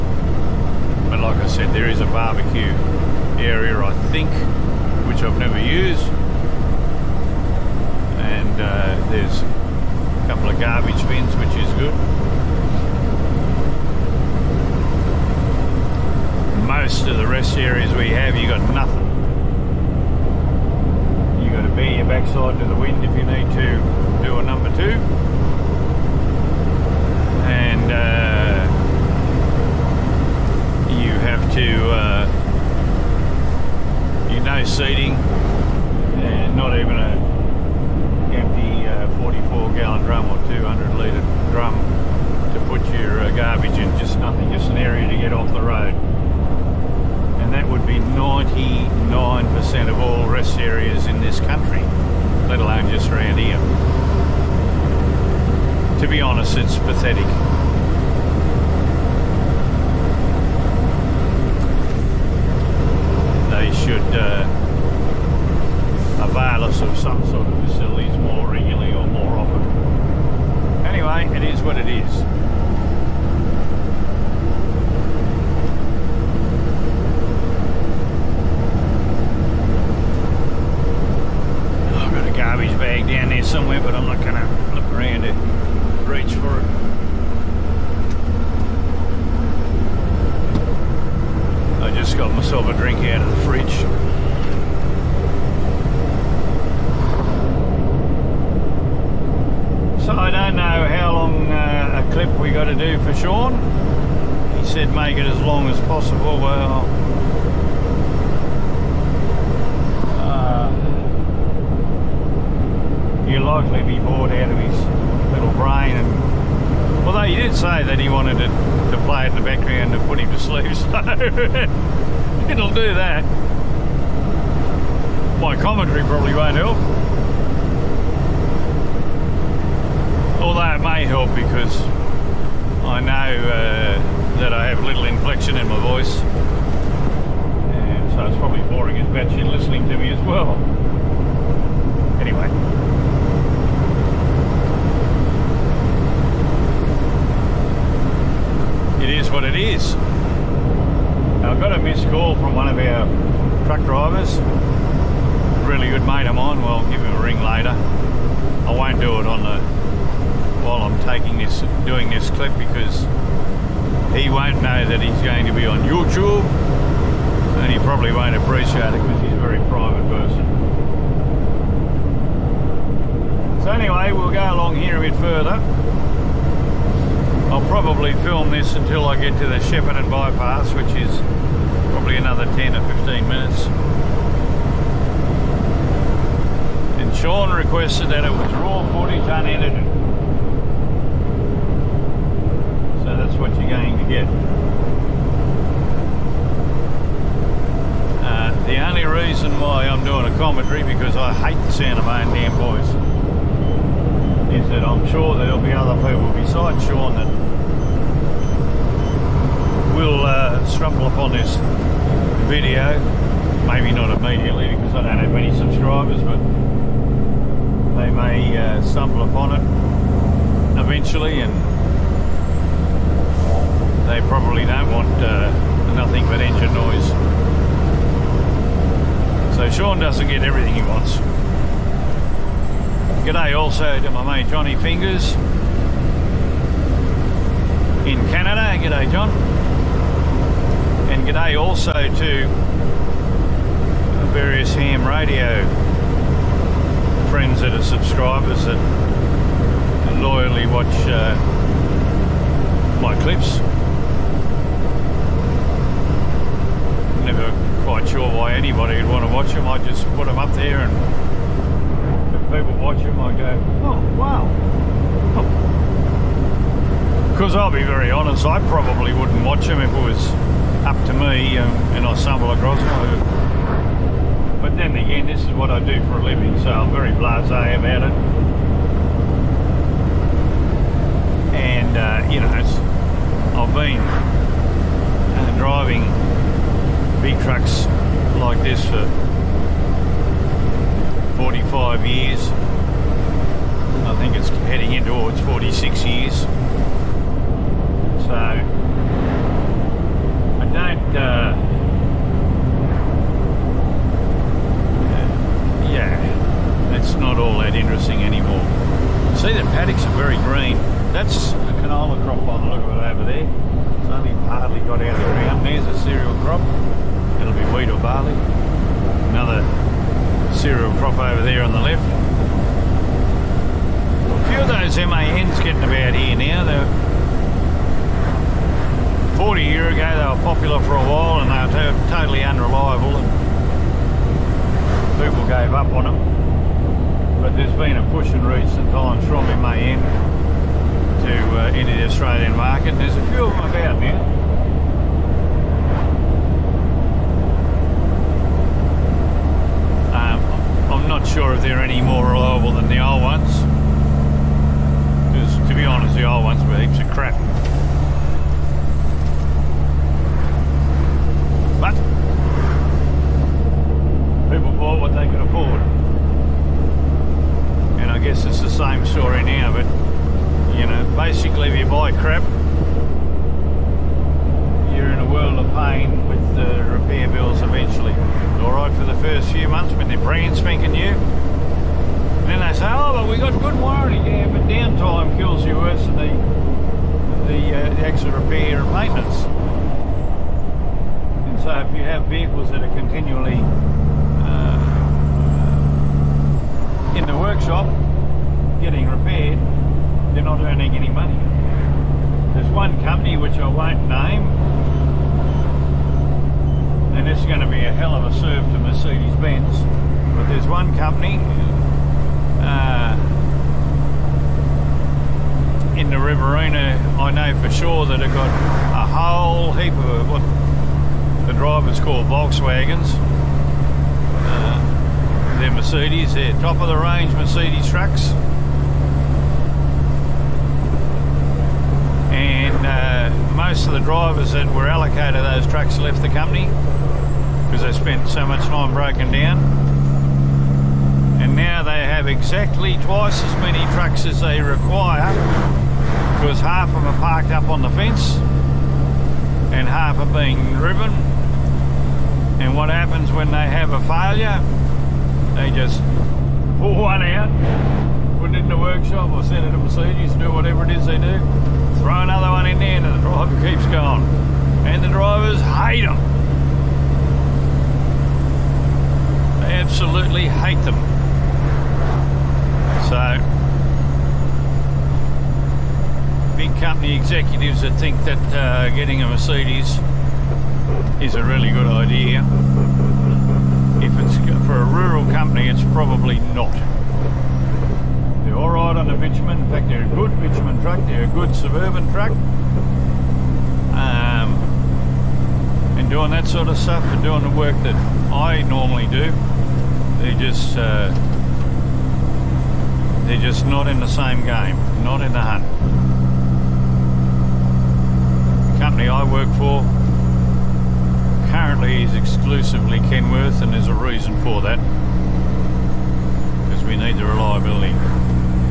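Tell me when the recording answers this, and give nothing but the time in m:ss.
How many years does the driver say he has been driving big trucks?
4:51.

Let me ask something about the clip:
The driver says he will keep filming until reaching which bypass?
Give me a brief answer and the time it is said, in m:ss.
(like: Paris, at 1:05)
Shepparton bypass, at 2:59.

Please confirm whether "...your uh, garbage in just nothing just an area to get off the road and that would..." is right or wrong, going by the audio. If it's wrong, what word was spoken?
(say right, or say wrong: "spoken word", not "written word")
right.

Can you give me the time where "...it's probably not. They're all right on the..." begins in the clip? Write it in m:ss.
8:05.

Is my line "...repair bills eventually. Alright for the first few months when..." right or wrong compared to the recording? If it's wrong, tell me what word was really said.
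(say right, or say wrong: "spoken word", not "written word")
right.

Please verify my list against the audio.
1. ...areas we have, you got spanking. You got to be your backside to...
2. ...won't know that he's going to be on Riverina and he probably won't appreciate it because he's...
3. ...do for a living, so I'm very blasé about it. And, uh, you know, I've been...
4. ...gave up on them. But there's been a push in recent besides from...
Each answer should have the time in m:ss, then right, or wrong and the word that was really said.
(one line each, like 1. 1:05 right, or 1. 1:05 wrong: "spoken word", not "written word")
1. 0:17 wrong: "nothing", not "spanking"
2. 2:44 wrong: "YouTube", not "Riverina"
3. 4:35 right
4. 5:35 wrong: "times", not "besides".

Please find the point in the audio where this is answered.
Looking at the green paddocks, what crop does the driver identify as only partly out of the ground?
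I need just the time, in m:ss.
5:11.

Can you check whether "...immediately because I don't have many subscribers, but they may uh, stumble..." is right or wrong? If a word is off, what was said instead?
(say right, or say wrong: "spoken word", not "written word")
right.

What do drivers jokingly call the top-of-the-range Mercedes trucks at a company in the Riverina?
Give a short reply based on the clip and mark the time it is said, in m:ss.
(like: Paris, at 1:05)
Volkswagens, at 7:02.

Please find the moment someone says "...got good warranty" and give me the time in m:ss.
6:23.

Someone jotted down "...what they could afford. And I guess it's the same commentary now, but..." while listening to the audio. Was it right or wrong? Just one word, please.
wrong.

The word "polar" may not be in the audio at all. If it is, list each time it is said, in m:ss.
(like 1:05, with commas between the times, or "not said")
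not said.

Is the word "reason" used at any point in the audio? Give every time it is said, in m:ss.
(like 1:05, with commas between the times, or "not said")
3:19, 8:33.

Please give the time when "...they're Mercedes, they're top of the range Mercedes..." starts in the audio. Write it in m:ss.
7:05.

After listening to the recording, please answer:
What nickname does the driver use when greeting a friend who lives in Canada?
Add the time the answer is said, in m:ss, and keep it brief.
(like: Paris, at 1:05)
Johnny Fingers, at 3:54.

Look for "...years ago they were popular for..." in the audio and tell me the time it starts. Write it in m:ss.
5:29.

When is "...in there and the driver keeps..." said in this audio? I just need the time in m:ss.
7:42.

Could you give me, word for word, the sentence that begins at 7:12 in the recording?
And uh, most of the drivers that were allocated those trucks left the company because they spent so much time broken down.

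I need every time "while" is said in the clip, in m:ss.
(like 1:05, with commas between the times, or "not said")
2:40, 5:30.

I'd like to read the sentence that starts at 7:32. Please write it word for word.
And what happens when they have a failure?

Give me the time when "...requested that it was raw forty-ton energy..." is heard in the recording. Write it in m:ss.
3:07.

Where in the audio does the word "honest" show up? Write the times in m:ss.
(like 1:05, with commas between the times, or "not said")
0:56, 4:28, 5:55.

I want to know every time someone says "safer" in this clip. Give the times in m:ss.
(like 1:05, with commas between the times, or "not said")
not said.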